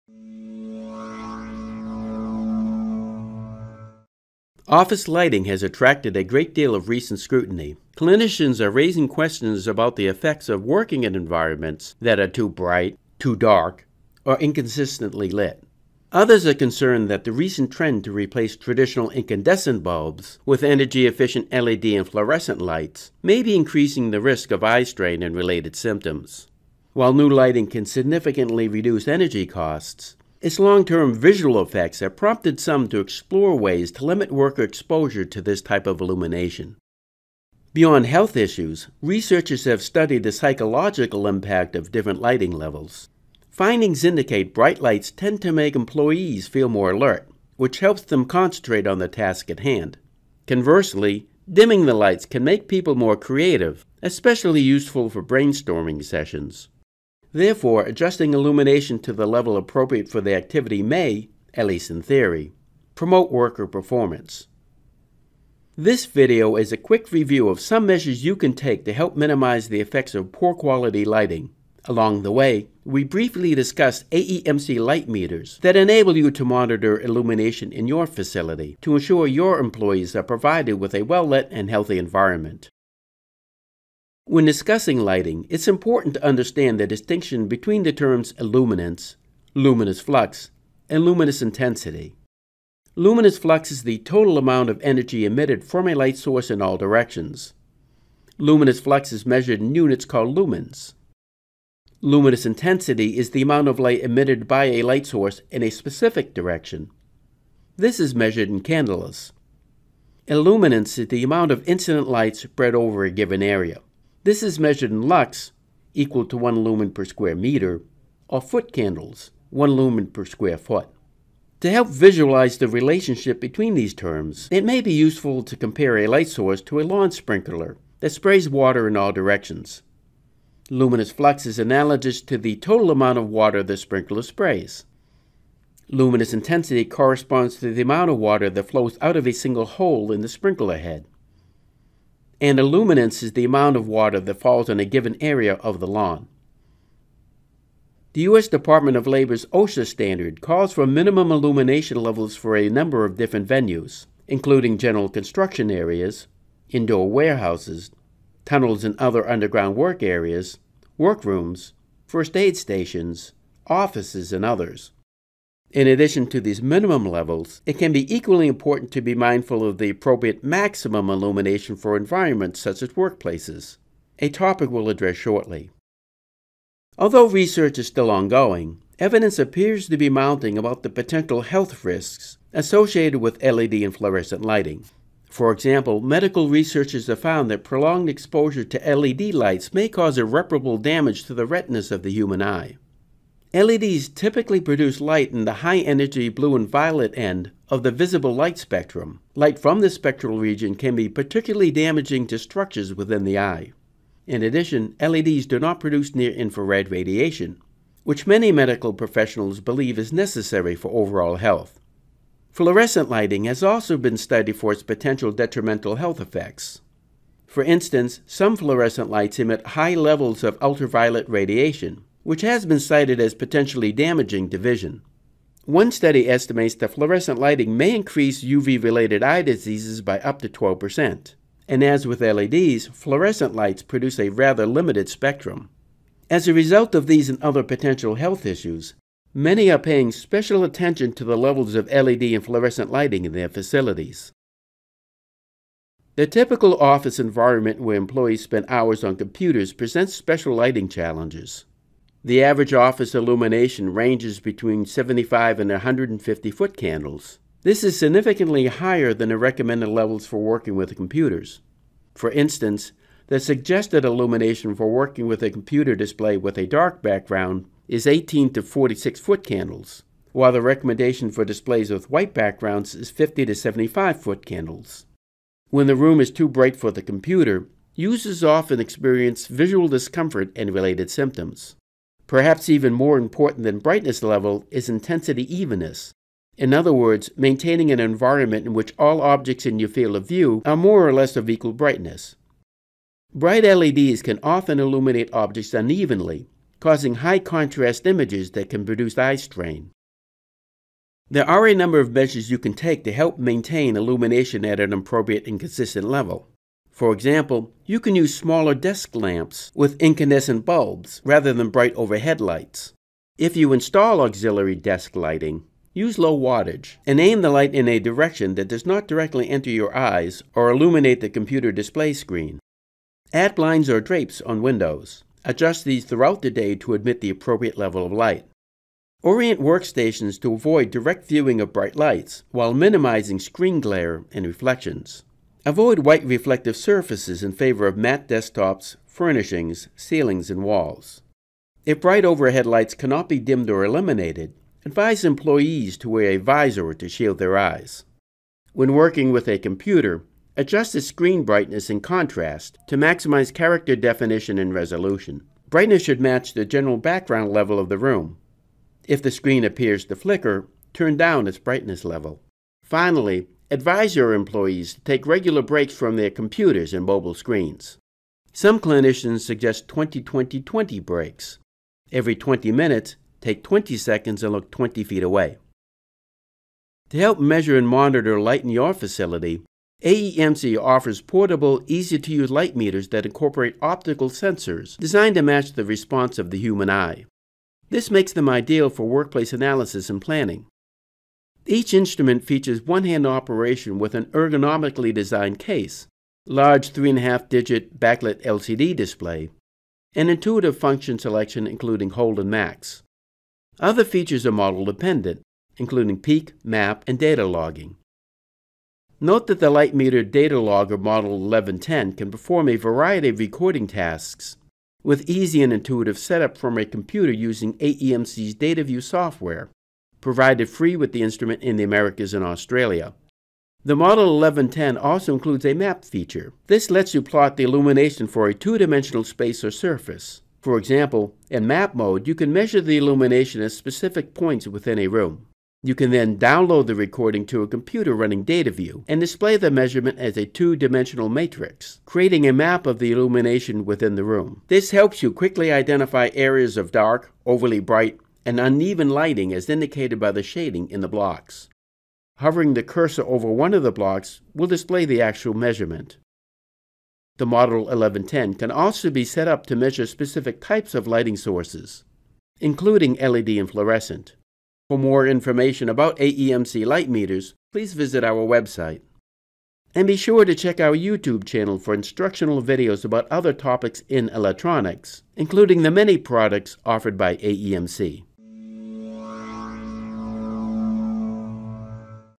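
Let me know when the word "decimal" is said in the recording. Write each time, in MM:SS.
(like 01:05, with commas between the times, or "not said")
not said.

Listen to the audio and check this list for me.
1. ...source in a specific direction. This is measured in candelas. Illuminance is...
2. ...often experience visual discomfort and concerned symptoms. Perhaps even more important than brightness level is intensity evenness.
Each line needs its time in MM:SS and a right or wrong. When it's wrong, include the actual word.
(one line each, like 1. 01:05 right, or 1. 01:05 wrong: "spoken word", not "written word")
1. 01:45 right
2. 04:38 wrong: "related", not "concerned".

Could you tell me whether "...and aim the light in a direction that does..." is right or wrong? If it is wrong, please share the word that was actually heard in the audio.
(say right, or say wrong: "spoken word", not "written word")
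right.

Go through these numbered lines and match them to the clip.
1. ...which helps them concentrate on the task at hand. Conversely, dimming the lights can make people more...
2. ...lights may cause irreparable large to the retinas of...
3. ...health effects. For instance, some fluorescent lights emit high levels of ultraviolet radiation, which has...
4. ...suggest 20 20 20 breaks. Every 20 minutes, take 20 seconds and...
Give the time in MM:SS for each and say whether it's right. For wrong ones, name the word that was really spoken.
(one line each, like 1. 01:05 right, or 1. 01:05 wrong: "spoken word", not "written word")
1. 00:47 right
2. 03:09 wrong: "damage", not "large"
3. 03:35 right
4. 06:09 right.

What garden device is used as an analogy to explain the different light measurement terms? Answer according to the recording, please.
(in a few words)
Lawn sprinkler.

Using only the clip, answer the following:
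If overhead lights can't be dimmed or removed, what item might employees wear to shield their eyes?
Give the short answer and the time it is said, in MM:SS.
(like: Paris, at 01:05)
A visor, at 05:46.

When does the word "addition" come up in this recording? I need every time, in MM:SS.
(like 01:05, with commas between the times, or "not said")
02:45, 03:24.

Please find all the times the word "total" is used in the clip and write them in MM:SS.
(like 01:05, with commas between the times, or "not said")
01:33, 02:12.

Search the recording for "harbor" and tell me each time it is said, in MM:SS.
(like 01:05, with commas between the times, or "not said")
not said.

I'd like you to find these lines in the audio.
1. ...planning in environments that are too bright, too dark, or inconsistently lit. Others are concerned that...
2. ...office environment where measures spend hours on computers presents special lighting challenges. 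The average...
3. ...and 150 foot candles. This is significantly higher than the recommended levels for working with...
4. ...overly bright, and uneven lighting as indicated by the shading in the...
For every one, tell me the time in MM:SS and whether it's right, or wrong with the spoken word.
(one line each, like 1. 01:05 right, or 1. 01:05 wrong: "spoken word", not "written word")
1. 00:10 wrong: "working", not "planning"
2. 04:06 wrong: "employees", not "measures"
3. 04:15 right
4. 07:27 right.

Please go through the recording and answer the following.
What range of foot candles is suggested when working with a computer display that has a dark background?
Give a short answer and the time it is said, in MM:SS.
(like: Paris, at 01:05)
18 to 46 foot candles, at 04:28.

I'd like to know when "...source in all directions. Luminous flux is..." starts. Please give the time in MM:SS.
01:36.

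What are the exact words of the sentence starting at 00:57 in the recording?
Therefore, adjusting illumination to the level appropriate for the activity may, at least in theory, promote worker performance.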